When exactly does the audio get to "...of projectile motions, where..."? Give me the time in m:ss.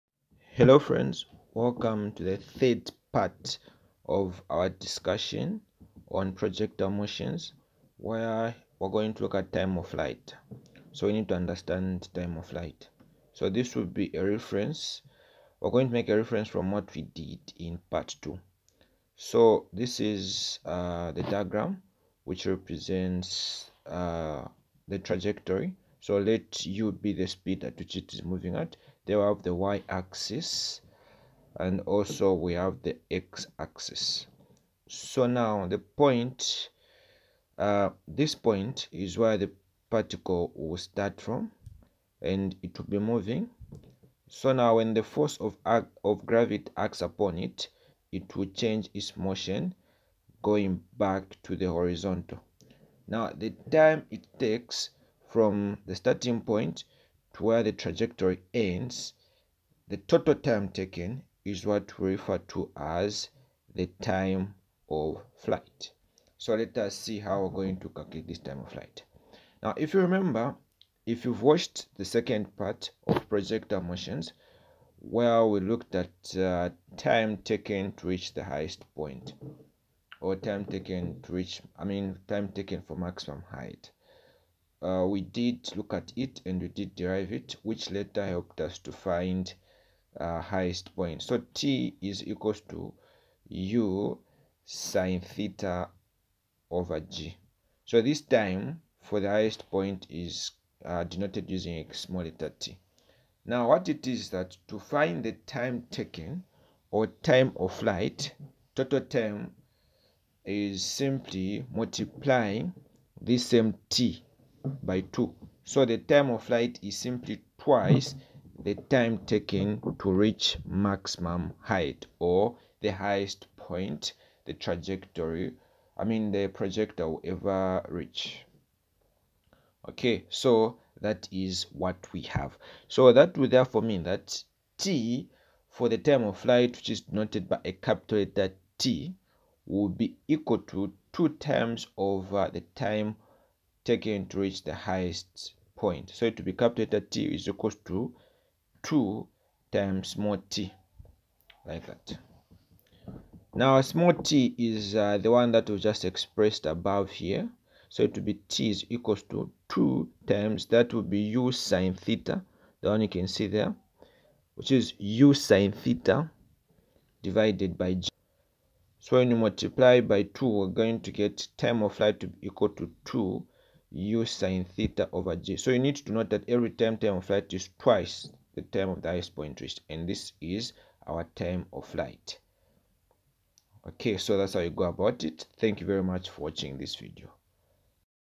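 1:13.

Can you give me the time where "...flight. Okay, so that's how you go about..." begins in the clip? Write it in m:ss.
3:01.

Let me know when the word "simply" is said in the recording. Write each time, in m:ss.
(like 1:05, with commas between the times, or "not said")
1:50, 1:56.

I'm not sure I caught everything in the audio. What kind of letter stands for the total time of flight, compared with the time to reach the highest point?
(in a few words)
Capital letter T.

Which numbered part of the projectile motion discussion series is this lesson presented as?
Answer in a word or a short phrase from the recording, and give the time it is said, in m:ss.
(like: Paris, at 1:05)
Third, at 0:02.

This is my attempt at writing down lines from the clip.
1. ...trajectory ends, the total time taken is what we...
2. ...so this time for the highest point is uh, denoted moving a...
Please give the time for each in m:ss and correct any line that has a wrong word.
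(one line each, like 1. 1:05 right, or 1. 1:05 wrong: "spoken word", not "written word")
1. 0:57 right
2. 1:37 wrong: "using", not "moving".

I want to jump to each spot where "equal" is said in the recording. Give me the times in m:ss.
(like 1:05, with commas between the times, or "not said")
1:32, 2:20, 2:27, 2:38, 2:52.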